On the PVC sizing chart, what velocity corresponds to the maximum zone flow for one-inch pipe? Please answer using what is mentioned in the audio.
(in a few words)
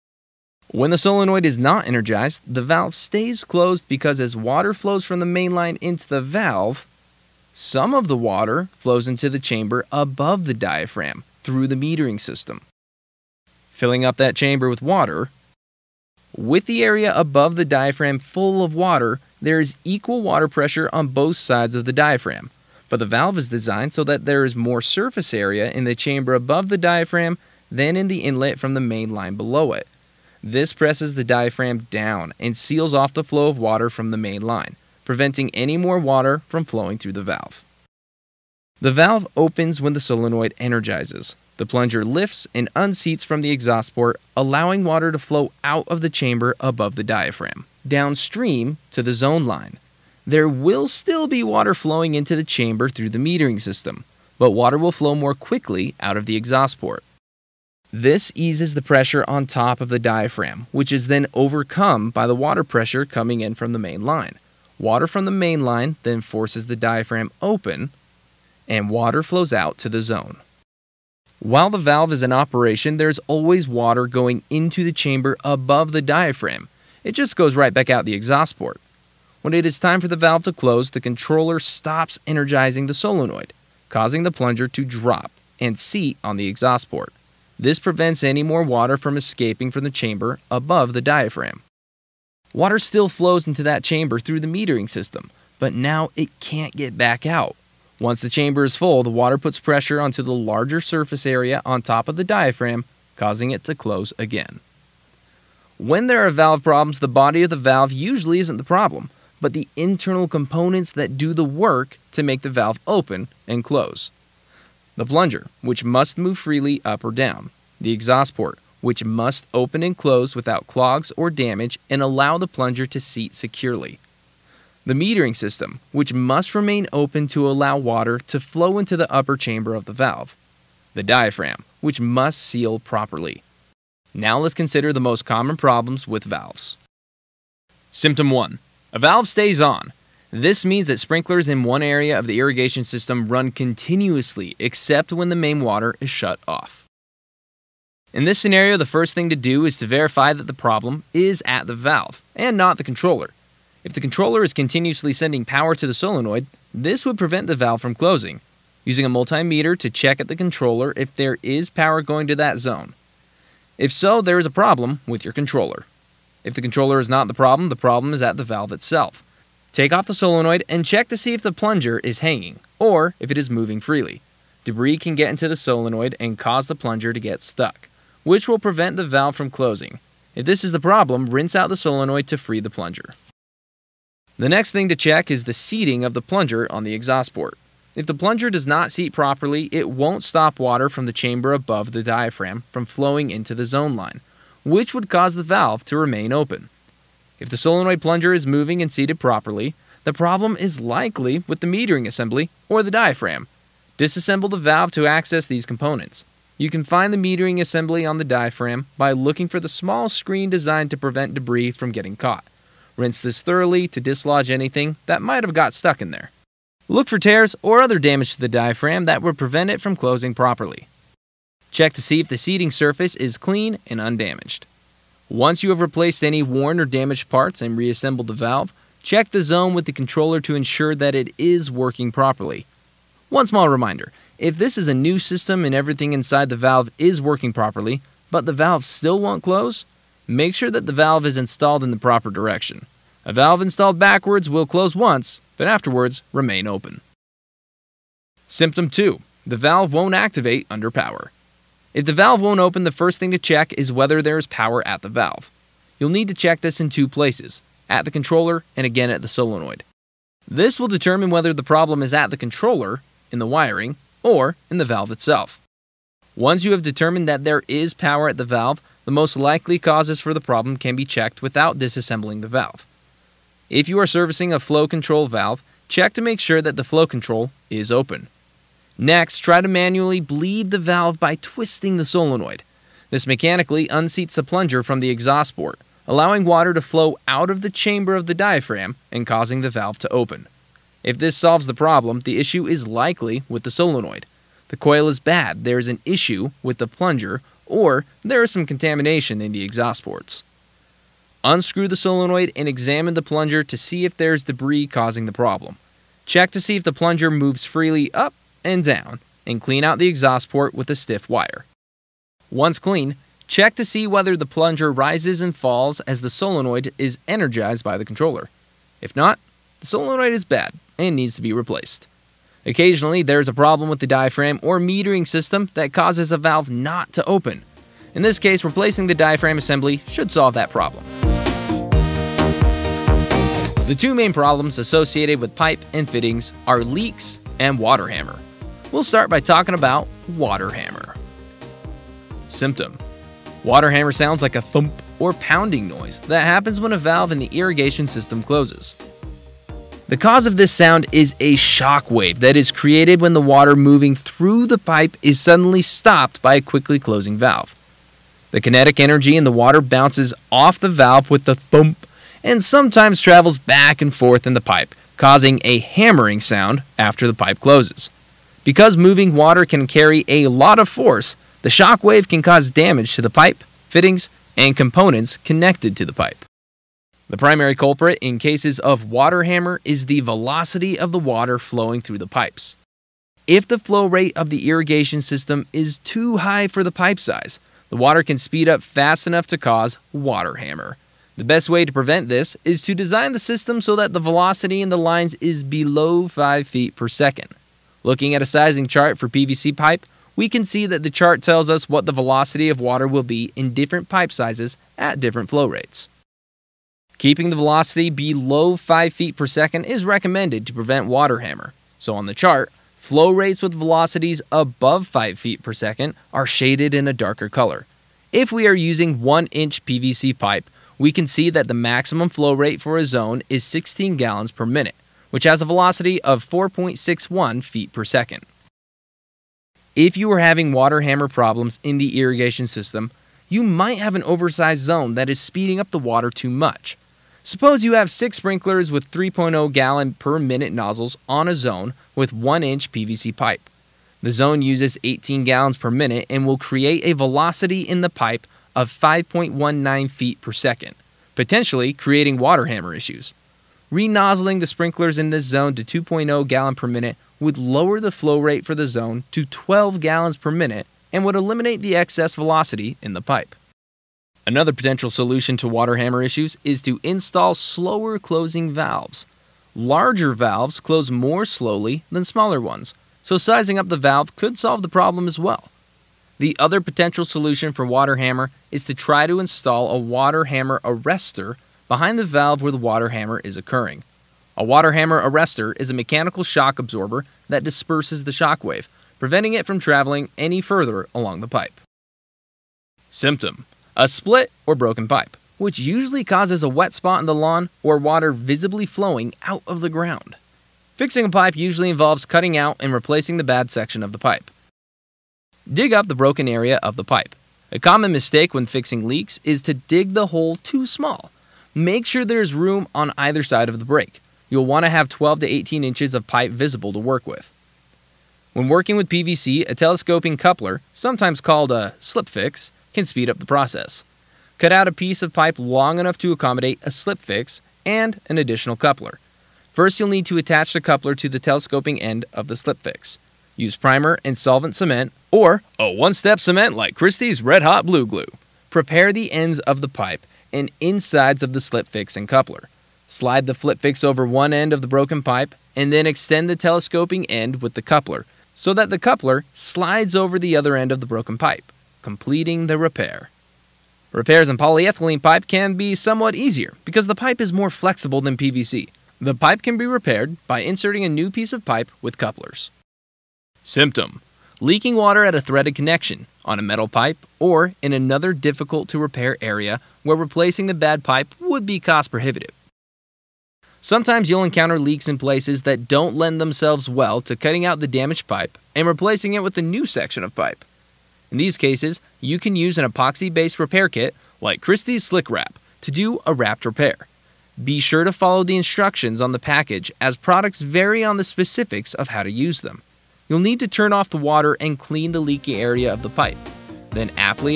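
4.61 feet per second.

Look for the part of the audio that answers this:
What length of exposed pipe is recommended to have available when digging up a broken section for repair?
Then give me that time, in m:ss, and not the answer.
8:35.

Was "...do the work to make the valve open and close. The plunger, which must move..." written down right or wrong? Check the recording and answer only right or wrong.
right.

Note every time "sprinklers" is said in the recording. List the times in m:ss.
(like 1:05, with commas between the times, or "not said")
2:20, 7:18, 7:34.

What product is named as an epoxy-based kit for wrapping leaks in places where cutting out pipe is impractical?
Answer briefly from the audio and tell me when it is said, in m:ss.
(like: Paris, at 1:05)
Christy's Slick Wrap, at 9:44.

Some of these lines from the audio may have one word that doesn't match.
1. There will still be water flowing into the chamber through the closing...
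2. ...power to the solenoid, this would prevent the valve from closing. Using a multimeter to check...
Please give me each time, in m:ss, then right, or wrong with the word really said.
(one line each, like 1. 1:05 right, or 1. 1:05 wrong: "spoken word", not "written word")
1. 0:50 wrong: "metering", not "closing"
2. 2:35 right.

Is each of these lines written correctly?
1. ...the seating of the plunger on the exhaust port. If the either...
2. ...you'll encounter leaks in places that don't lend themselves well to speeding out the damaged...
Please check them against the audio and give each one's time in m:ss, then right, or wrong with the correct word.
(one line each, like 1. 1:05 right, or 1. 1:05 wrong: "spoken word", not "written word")
1. 3:05 wrong: "plunger", not "either"
2. 9:34 wrong: "cutting", not "speeding".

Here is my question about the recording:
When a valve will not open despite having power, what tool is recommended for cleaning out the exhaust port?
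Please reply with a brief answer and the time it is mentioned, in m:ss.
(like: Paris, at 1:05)
stiff wire, at 5:10.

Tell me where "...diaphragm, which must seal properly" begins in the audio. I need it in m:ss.
2:11.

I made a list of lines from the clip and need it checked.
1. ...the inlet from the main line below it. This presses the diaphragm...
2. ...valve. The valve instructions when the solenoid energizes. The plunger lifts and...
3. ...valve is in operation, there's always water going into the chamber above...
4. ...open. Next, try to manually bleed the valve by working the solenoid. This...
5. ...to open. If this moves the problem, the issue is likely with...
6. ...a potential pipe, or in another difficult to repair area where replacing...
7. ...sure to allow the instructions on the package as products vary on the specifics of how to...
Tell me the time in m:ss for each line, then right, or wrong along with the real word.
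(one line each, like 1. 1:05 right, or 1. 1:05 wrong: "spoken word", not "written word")
1. 0:28 right
2. 0:37 wrong: "opens", not "instructions"
3. 1:11 right
4. 4:37 wrong: "twisting", not "working"
5. 4:49 wrong: "solves", not "moves"
6. 9:26 wrong: "metal", not "potential"
7. 9:47 wrong: "follow", not "allow".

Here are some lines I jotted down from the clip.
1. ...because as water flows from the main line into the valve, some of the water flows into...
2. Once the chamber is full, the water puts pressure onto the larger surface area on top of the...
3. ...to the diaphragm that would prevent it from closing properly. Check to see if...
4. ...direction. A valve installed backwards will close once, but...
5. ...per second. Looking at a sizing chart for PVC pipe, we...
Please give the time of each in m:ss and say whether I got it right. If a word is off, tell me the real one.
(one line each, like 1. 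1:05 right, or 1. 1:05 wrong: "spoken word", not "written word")
1. 0:03 right
2. 1:37 right
3. 3:38 right
4. 4:02 right
5. 6:36 right.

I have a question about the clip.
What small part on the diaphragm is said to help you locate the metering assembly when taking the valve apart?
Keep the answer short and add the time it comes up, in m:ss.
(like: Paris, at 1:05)
small screen, at 3:29.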